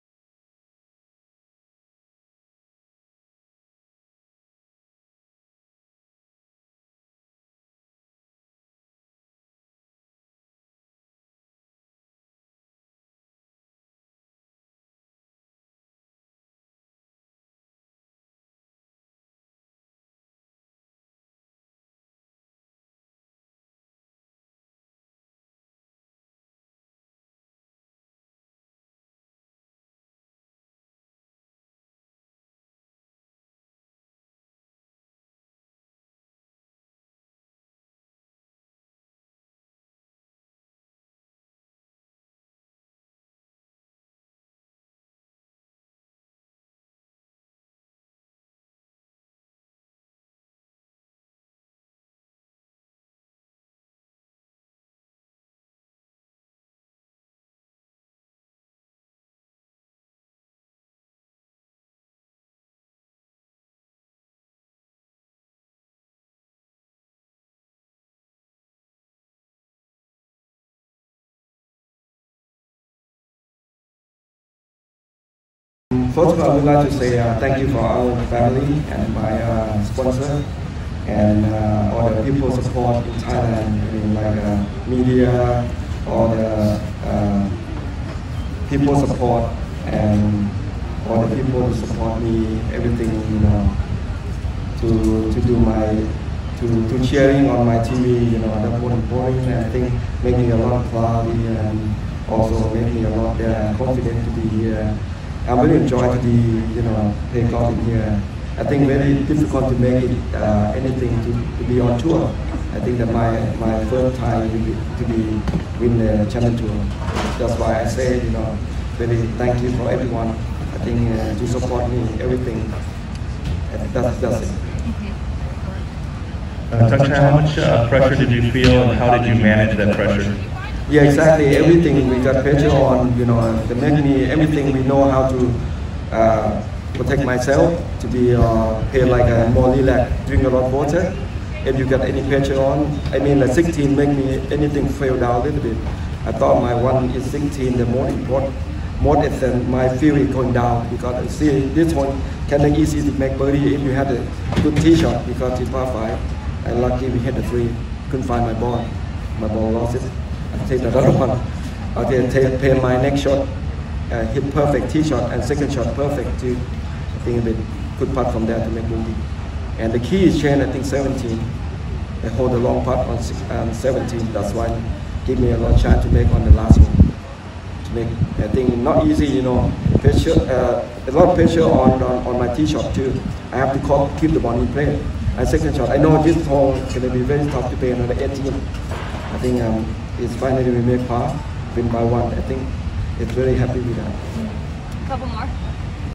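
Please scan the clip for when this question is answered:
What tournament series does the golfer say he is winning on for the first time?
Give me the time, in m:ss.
1:56.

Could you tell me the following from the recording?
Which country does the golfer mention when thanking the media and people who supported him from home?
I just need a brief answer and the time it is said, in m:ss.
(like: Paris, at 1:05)
Thailand, at 1:23.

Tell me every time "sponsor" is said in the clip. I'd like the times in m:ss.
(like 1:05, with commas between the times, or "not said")
1:19.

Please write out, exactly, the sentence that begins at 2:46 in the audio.
I think bit good putt from there to make birdie.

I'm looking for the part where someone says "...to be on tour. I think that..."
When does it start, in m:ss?
1:51.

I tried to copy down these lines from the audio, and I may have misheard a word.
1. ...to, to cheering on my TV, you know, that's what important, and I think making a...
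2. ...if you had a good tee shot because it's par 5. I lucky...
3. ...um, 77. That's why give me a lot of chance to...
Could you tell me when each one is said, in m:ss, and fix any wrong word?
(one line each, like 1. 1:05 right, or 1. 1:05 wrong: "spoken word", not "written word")
1. 1:36 right
2. 2:33 right
3. 2:53 wrong: "17", not "77".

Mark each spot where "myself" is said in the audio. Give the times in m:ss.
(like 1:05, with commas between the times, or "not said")
2:17.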